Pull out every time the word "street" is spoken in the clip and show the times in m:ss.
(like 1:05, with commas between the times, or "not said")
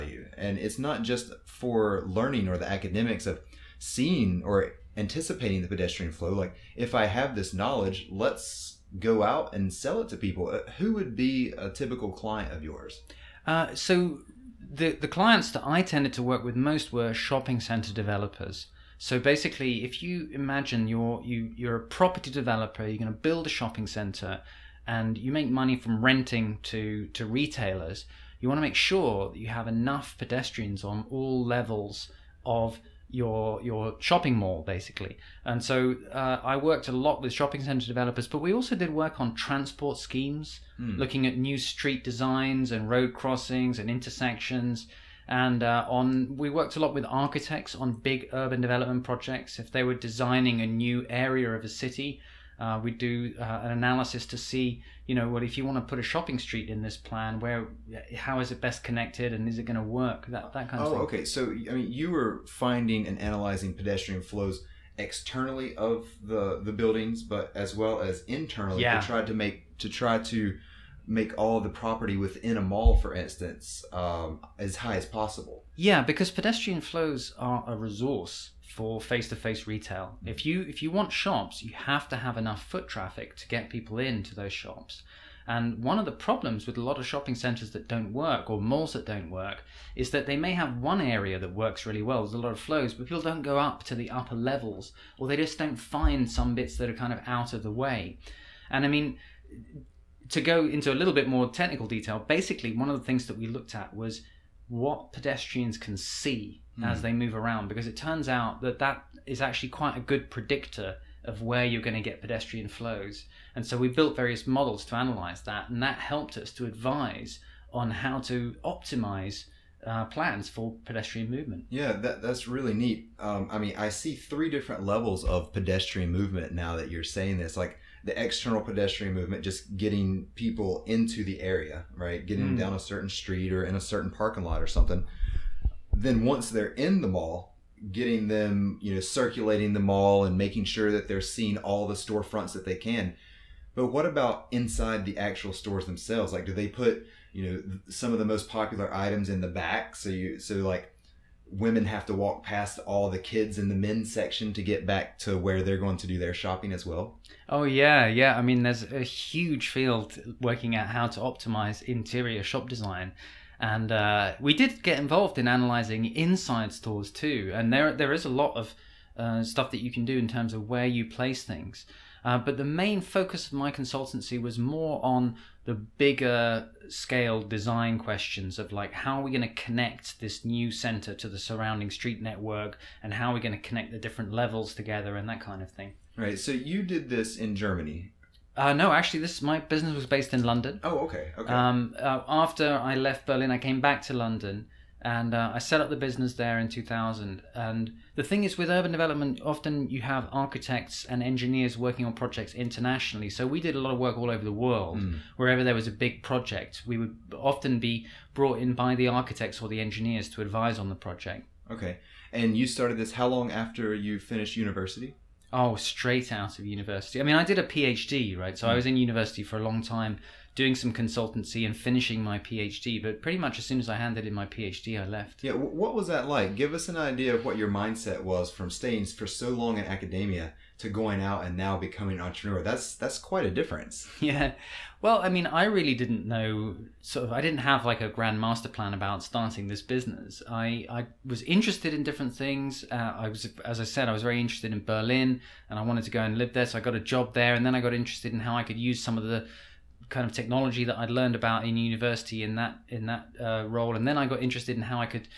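0:41, 0:56, 2:13, 3:01.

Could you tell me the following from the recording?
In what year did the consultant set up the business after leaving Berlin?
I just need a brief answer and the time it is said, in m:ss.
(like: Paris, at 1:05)
2000, at 3:16.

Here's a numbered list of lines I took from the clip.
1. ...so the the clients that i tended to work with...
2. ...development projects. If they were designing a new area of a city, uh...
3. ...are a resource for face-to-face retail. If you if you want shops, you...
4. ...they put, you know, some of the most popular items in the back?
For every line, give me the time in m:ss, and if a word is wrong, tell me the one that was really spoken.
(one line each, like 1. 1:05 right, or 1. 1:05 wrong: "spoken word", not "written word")
1. 0:13 right
2. 0:48 right
3. 1:17 right
4. 2:26 right.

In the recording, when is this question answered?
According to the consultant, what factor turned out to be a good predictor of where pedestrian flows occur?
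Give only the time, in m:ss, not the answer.
1:44.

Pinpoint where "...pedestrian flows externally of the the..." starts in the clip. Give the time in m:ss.
1:03.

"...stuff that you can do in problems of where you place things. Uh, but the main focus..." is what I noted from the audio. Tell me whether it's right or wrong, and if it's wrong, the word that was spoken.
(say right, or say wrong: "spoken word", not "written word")
wrong: "terms", not "problems".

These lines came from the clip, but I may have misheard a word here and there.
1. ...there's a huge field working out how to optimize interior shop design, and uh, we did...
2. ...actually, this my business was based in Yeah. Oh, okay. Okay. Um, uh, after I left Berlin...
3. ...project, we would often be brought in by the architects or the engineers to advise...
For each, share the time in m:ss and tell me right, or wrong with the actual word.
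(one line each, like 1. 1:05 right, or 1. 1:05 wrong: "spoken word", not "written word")
1. 2:38 right
2. 3:08 wrong: "London", not "Yeah"
3. 3:26 right.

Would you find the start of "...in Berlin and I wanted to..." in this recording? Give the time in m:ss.
4:04.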